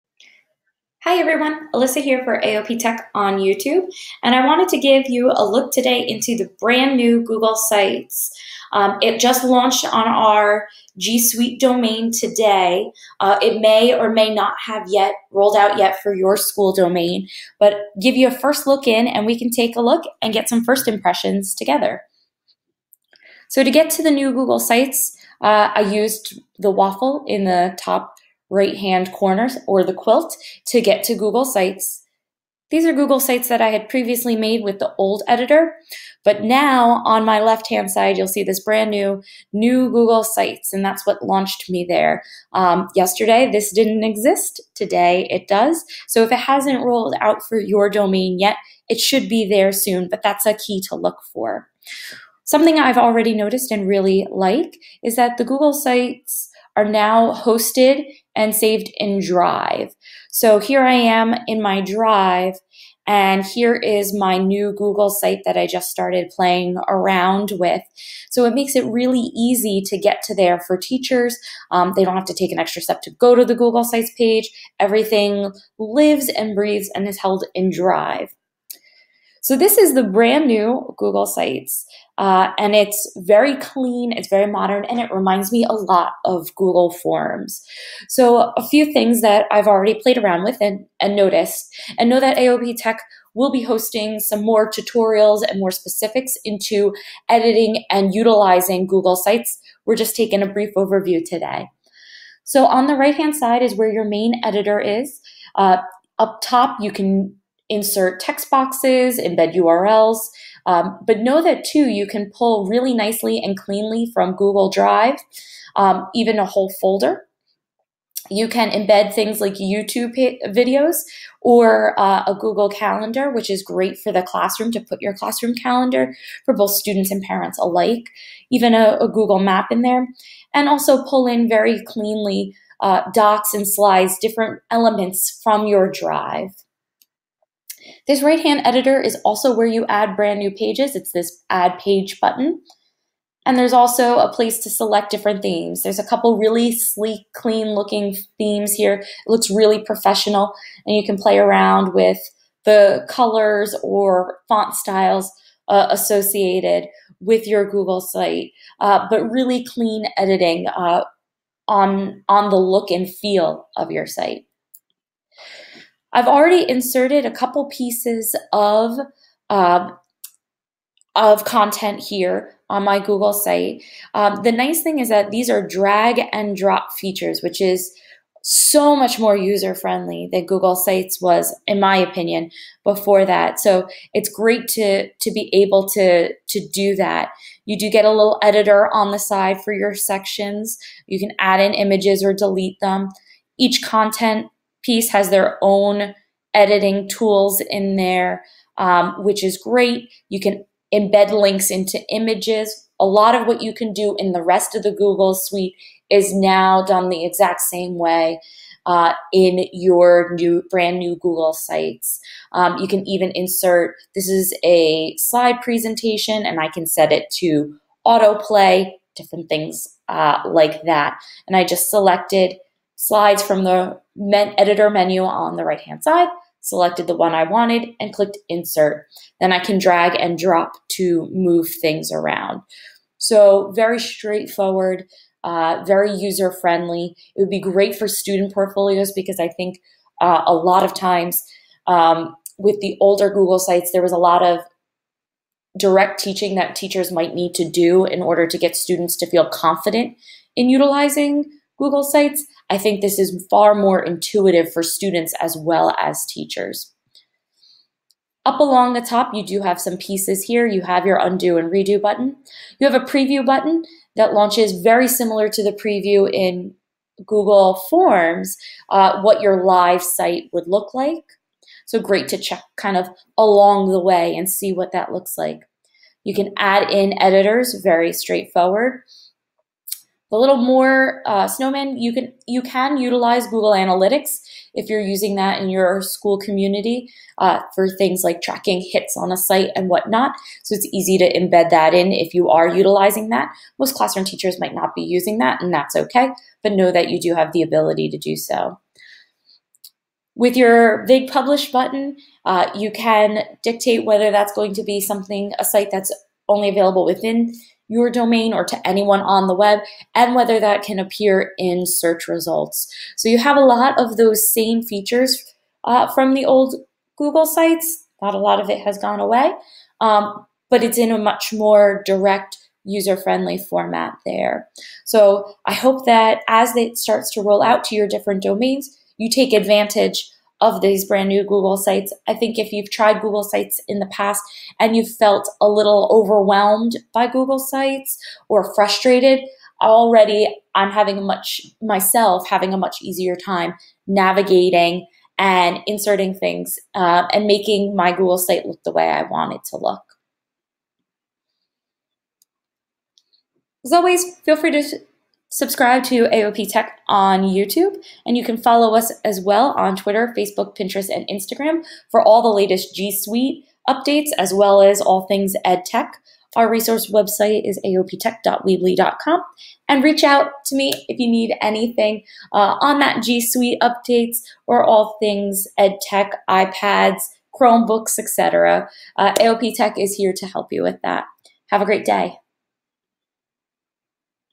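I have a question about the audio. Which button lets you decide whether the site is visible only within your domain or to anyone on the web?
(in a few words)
Publish.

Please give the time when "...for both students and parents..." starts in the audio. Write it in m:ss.
2:06.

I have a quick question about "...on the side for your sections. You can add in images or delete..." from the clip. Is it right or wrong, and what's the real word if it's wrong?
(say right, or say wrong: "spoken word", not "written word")
right.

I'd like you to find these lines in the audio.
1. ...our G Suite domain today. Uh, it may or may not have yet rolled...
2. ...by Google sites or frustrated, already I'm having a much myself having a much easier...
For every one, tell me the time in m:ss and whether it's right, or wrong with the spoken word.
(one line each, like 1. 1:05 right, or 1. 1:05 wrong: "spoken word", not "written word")
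1. 0:10 right
2. 5:37 right.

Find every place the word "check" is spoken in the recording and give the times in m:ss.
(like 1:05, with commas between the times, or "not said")
4:32.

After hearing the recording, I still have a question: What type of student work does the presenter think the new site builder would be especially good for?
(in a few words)
Student portfolios.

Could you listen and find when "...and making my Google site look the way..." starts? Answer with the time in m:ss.
5:47.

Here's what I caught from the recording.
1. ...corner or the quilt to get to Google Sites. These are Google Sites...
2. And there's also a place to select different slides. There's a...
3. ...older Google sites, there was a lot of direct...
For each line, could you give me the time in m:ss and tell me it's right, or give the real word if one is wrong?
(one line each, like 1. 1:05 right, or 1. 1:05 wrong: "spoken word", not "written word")
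1. 0:29 right
2. 2:23 wrong: "themes", not "slides"
3. 4:03 right.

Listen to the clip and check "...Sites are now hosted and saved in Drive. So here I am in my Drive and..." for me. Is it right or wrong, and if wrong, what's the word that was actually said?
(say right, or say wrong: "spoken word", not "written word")
right.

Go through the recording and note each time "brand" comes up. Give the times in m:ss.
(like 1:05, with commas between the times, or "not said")
0:06, 0:38, 1:20, 2:20, 3:30, 5:31.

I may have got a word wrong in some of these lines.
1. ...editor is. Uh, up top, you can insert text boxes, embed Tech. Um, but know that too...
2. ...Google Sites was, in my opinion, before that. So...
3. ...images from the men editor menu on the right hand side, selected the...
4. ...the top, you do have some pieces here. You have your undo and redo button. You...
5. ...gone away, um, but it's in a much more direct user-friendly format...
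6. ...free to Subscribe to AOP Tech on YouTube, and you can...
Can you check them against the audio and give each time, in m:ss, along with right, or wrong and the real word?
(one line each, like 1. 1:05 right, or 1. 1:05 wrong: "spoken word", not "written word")
1. 1:44 wrong: "URLs", not "Tech"
2. 3:00 right
3. 3:43 wrong: "slides", not "images"
4. 4:18 right
5. 5:18 right
6. 5:54 right.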